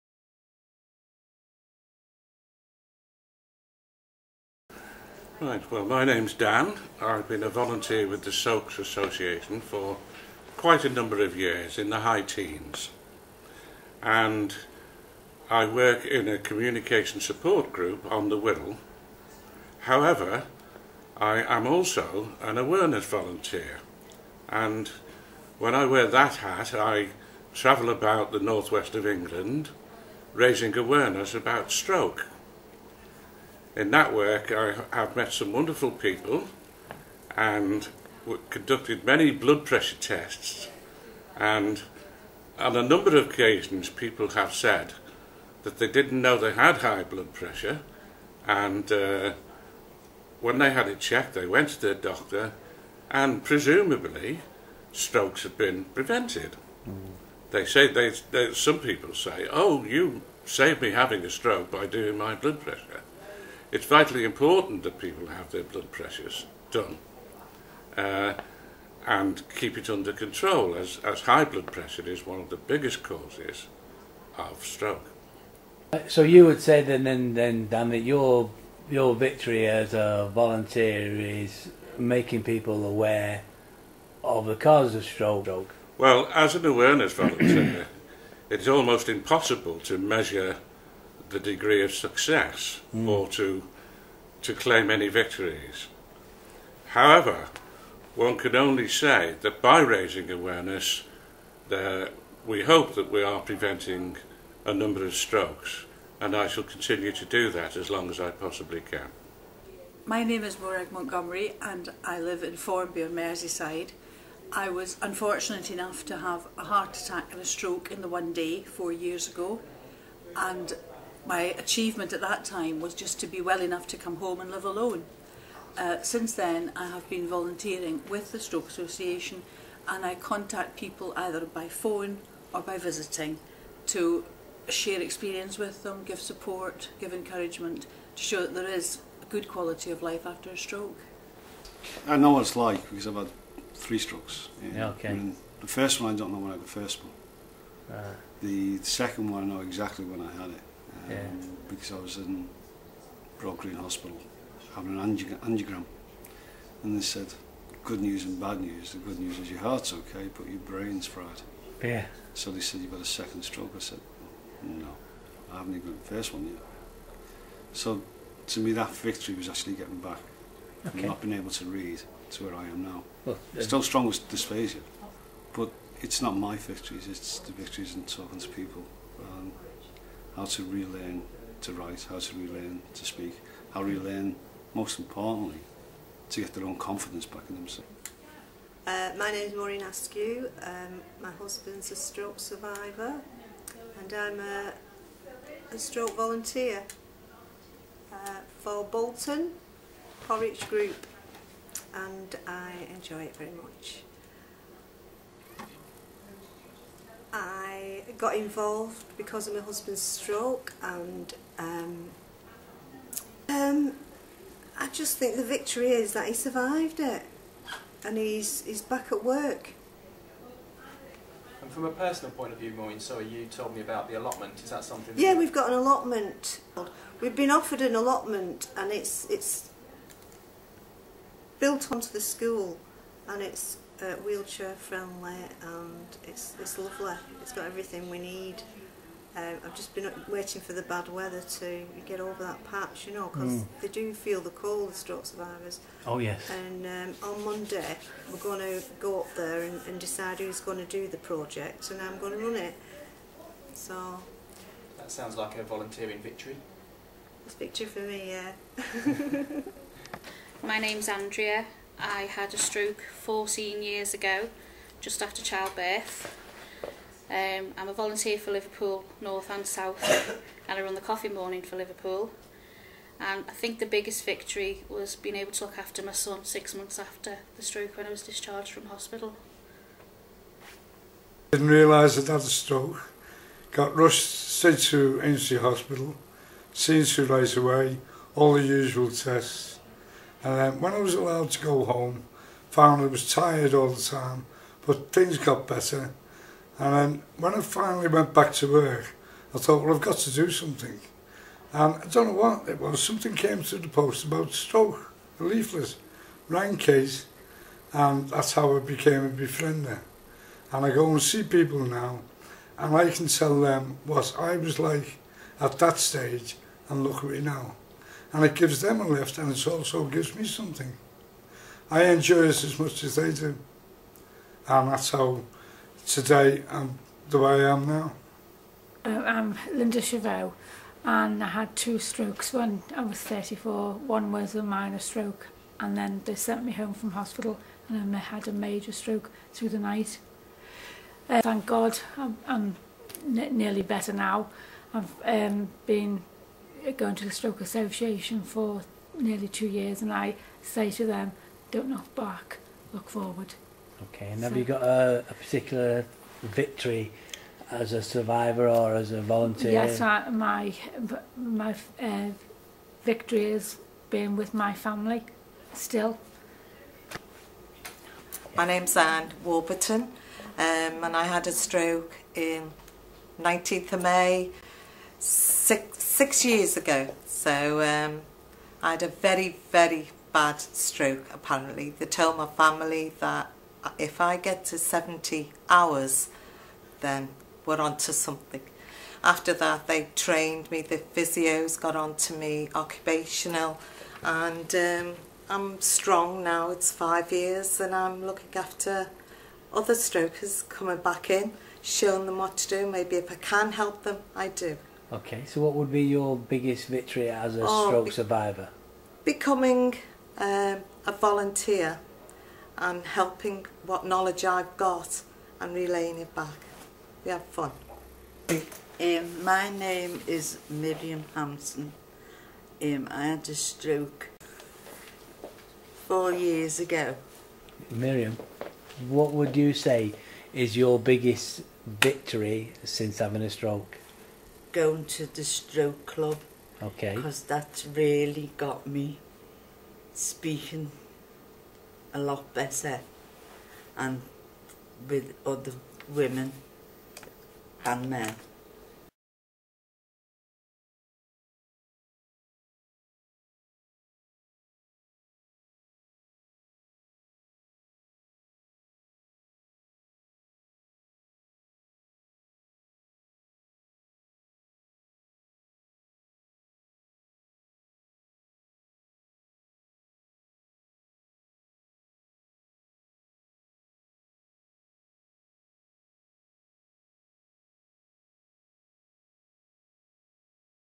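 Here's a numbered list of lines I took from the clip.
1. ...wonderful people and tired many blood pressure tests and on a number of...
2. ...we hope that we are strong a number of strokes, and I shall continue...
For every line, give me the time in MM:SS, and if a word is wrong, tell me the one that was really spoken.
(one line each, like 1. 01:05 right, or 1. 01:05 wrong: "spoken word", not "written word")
1. 00:35 wrong: "conducted", not "tired"
2. 01:42 wrong: "preventing", not "strong".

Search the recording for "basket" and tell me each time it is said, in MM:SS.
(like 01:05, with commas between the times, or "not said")
not said.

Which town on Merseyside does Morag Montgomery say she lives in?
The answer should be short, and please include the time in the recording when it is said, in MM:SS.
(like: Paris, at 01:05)
Formby, at 01:52.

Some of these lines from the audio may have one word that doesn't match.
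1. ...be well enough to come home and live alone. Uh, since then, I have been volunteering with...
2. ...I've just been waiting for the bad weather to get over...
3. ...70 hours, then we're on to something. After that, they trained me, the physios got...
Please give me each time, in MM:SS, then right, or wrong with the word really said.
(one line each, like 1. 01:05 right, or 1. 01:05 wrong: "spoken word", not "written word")
1. 02:03 right
2. 03:59 right
3. 06:24 right.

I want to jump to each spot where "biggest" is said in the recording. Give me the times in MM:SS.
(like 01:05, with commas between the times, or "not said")
01:12, 04:33, 06:46, 07:10.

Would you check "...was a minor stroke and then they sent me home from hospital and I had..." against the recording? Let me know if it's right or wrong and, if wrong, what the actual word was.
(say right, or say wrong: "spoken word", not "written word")
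right.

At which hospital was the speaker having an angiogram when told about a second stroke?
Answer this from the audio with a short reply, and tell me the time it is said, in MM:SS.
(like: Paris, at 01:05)
Broad Green Hospital, at 02:33.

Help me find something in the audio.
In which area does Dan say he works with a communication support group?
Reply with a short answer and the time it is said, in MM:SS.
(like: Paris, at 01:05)
the Wirral, at 00:18.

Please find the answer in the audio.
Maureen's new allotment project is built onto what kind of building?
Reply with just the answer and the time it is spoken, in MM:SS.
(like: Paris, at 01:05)
the school, at 03:52.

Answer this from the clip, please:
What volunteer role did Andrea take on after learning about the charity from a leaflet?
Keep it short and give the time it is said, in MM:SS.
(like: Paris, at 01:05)
befriender, at 05:09.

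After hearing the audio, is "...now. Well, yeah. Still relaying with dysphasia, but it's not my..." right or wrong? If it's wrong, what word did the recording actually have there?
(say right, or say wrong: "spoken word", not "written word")
wrong: "strong", not "relaying".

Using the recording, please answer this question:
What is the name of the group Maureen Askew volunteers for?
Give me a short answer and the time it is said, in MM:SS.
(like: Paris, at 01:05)
Bolton Porridge Group, at 03:18.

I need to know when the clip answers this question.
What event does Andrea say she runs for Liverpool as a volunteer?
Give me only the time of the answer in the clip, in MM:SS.
04:30.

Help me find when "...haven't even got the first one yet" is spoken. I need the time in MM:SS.
02:45.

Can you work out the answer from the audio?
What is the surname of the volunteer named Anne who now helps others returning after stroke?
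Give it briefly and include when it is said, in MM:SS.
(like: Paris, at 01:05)
Warburton, at 06:09.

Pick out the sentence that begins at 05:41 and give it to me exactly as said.
Uh, thank God I'm, I'm nearly better now.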